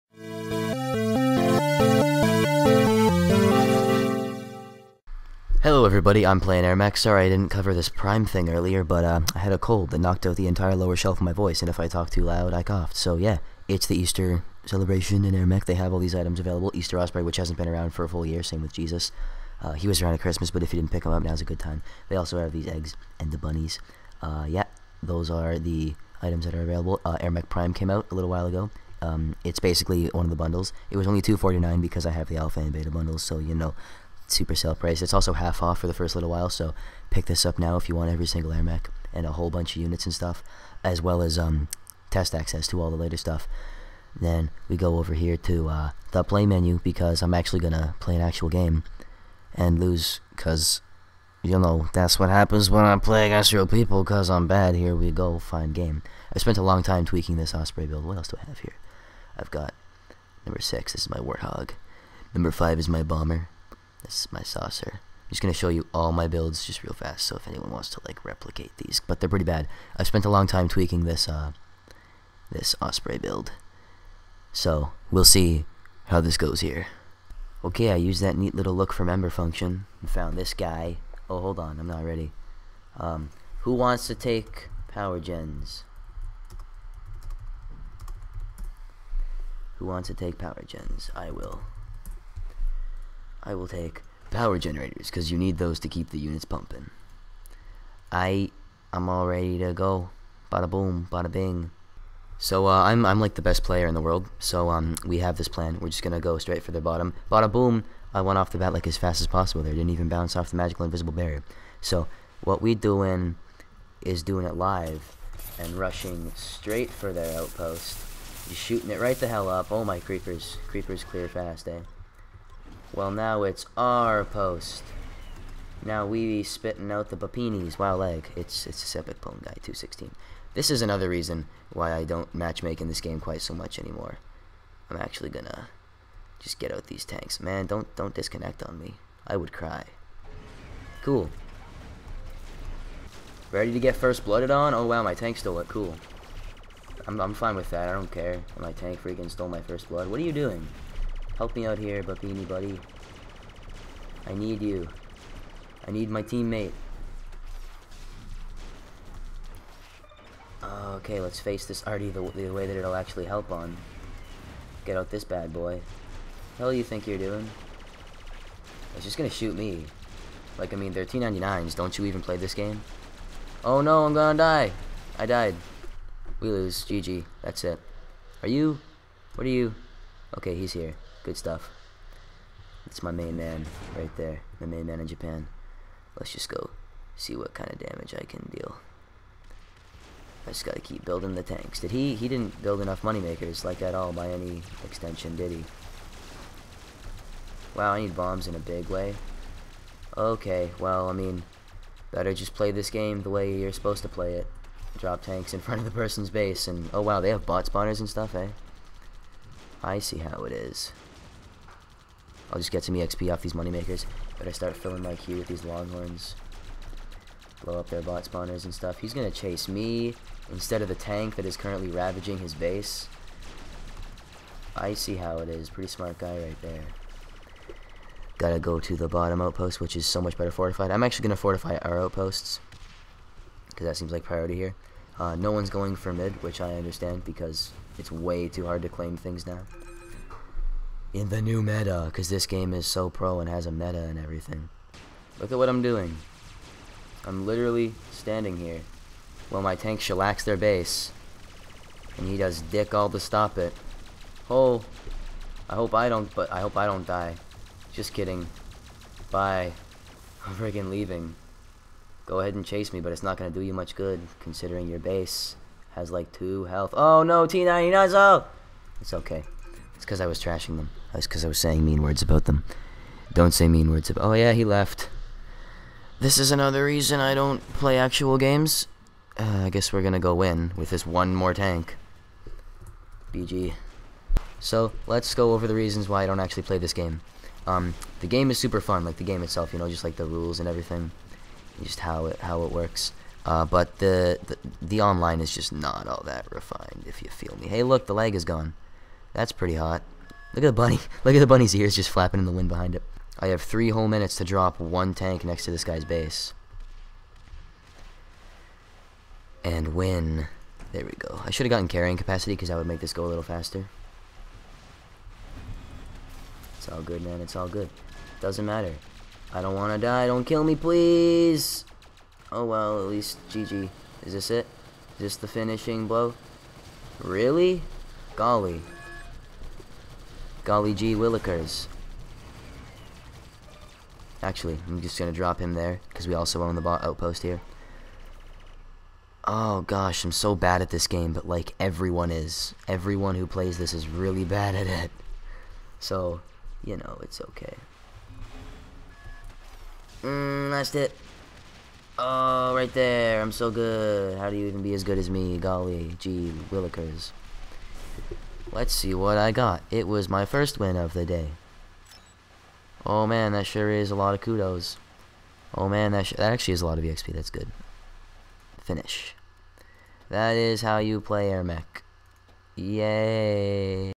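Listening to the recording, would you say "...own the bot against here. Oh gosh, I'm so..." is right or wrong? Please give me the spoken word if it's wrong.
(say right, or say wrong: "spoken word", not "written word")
wrong: "outpost", not "against".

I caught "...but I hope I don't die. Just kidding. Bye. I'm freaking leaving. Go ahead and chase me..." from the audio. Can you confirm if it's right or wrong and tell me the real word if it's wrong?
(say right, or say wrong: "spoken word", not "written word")
right.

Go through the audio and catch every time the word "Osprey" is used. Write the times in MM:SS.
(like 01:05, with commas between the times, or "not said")
00:16, 00:57, 01:12.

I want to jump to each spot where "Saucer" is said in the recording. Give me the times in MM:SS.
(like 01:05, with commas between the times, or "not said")
01:04.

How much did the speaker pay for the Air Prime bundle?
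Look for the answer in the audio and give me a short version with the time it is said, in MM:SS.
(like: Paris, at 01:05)
249, at 00:31.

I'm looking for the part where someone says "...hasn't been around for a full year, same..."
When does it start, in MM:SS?
00:17.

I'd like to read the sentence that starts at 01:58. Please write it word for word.
Just shooting it right the hell up.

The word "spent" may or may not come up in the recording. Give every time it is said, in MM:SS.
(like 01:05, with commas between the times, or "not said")
00:56, 01:10.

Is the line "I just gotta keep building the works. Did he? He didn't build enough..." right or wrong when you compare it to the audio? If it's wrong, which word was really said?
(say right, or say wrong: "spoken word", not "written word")
wrong: "tanks", not "works".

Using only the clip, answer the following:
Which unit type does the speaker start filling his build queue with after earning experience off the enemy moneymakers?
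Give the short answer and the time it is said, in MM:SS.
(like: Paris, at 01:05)
longhorns, at 03:35.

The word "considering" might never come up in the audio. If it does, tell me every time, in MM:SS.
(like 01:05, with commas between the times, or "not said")
04:24.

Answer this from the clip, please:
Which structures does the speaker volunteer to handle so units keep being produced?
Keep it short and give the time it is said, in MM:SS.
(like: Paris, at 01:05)
power generators, at 01:34.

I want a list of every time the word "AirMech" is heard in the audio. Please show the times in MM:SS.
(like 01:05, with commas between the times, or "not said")
00:06, 00:38.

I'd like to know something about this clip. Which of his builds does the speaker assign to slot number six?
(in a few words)
Warthog.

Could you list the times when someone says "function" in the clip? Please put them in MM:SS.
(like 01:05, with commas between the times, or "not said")
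01:19.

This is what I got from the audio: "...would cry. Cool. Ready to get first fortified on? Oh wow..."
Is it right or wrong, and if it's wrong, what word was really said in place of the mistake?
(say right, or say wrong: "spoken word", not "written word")
wrong: "blooded", not "fortified".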